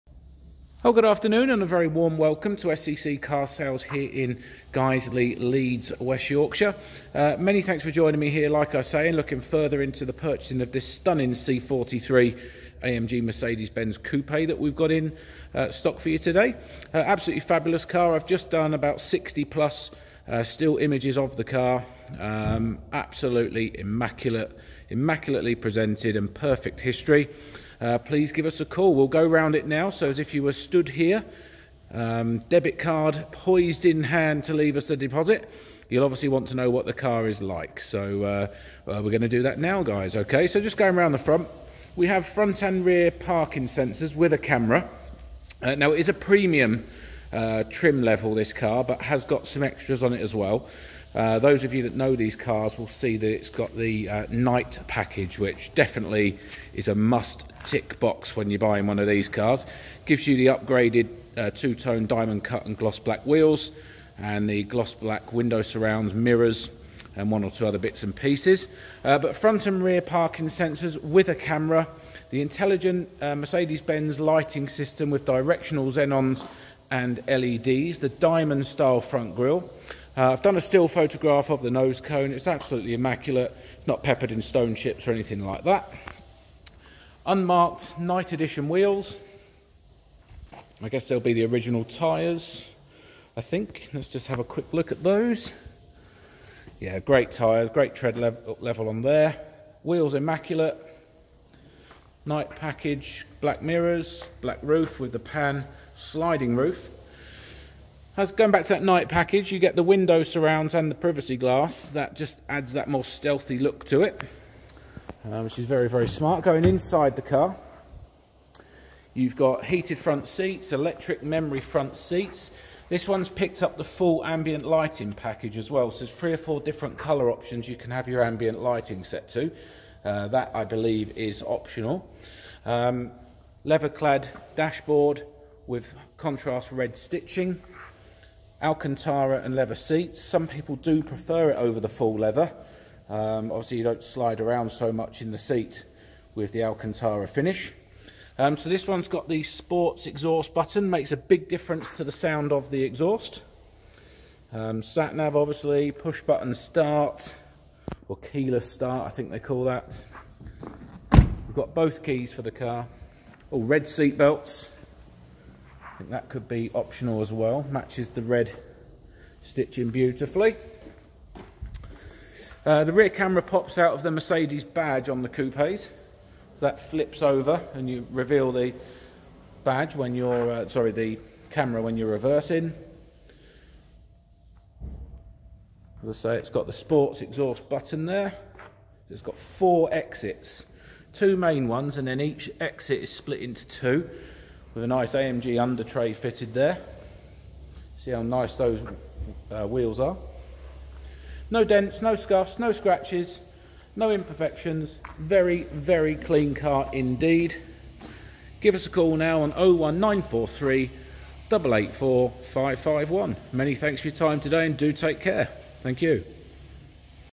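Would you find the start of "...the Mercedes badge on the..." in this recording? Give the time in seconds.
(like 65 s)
174 s.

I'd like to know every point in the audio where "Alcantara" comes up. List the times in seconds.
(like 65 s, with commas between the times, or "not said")
138 s, 146 s.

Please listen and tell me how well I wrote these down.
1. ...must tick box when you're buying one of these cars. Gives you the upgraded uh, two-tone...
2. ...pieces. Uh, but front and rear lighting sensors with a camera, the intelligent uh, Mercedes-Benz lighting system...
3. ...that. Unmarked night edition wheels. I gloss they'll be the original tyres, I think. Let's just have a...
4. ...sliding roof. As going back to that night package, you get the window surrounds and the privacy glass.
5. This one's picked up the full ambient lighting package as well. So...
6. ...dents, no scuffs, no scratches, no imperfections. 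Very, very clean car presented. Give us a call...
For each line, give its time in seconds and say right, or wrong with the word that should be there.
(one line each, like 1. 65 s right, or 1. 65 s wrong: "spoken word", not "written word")
1. 56 s right
2. 68 s wrong: "parking", not "lighting"
3. 85 s wrong: "guess", not "gloss"
4. 105 s right
5. 122 s right
6. 201 s wrong: "indeed", not "presented".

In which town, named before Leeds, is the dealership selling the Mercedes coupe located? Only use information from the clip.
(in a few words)
Guiseley.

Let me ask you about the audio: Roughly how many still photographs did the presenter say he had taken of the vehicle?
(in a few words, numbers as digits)
60.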